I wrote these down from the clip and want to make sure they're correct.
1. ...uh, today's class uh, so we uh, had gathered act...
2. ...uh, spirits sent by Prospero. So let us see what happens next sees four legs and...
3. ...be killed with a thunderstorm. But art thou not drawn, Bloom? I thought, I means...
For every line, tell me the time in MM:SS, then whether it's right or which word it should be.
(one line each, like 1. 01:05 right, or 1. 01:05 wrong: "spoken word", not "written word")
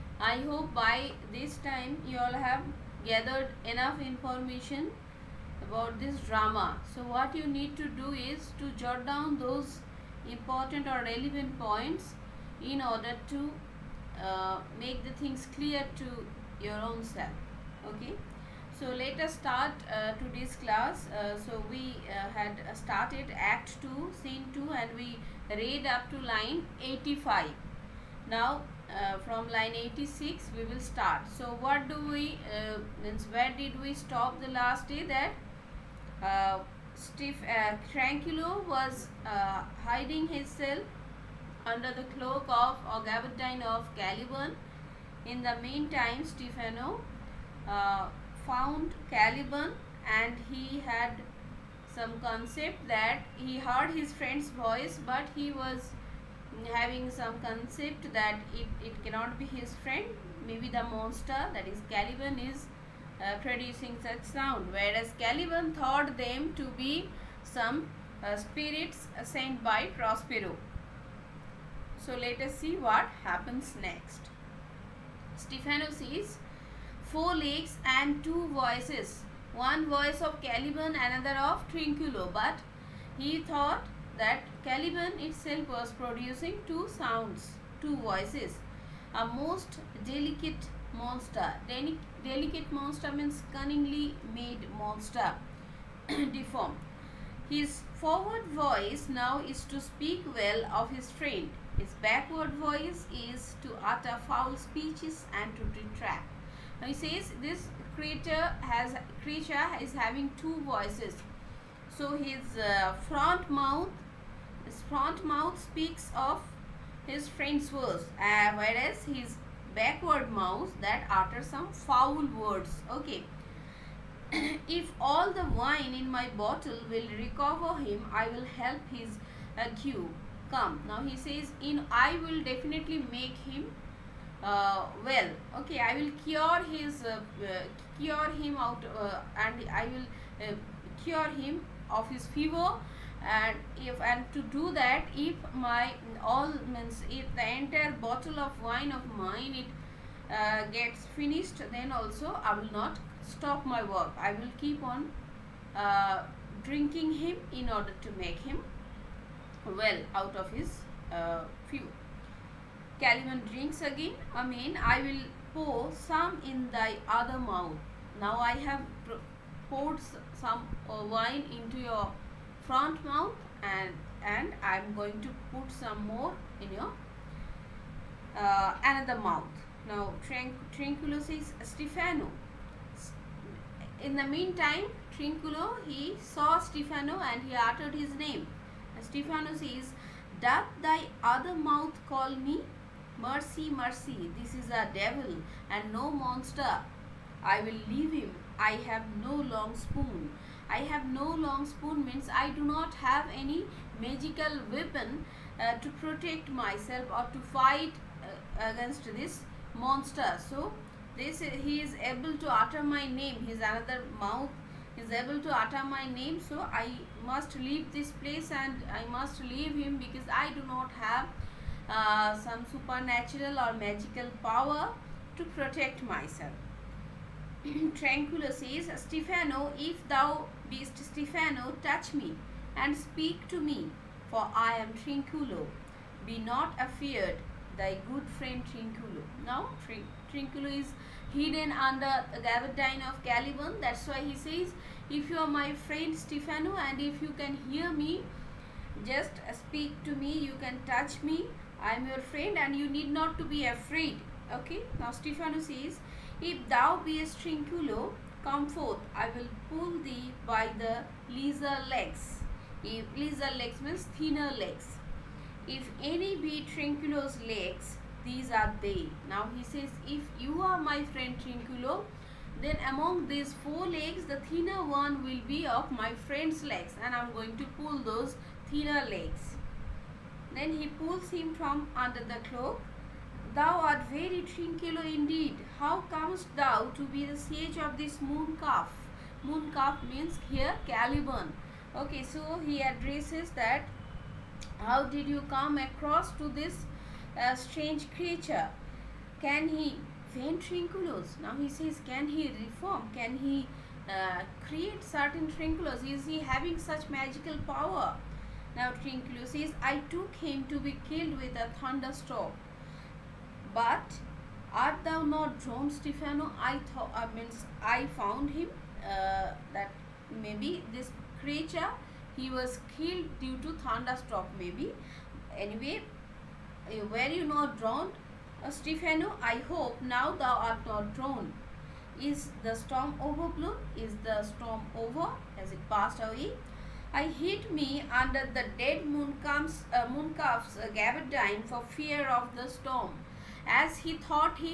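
1. 00:19 wrong: "started", not "gathered"
2. 01:08 right
3. 05:10 wrong: "Stefano", not "Bloom".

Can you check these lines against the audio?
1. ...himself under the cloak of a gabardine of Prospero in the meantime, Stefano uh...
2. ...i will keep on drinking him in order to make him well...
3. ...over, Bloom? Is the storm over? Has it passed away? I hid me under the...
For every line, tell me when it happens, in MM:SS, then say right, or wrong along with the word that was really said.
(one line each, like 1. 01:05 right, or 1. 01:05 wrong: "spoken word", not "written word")
1. 00:40 wrong: "Caliban", not "Prospero"
2. 02:34 right
3. 05:33 right.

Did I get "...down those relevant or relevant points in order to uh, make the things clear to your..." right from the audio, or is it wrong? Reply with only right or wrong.
wrong.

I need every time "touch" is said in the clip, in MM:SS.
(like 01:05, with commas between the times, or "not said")
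03:51, 04:10.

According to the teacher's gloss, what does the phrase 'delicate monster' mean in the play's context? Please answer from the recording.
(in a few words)
Cunningly made monster.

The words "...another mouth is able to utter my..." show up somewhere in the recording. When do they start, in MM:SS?
03:33.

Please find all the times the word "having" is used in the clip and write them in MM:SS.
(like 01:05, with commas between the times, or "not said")
00:56, 01:49, 05:06.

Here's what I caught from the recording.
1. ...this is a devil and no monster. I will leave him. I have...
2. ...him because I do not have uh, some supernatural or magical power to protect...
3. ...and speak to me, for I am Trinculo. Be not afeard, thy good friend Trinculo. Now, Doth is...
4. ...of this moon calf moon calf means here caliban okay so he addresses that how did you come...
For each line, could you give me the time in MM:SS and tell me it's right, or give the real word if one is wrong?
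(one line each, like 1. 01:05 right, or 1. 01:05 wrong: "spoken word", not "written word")
1. 03:14 right
2. 03:39 right
3. 03:52 wrong: "Trinculo", not "Doth"
4. 04:47 right.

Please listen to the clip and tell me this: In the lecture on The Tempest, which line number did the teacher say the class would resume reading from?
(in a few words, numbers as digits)
86.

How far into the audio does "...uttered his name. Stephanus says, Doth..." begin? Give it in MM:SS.
03:07.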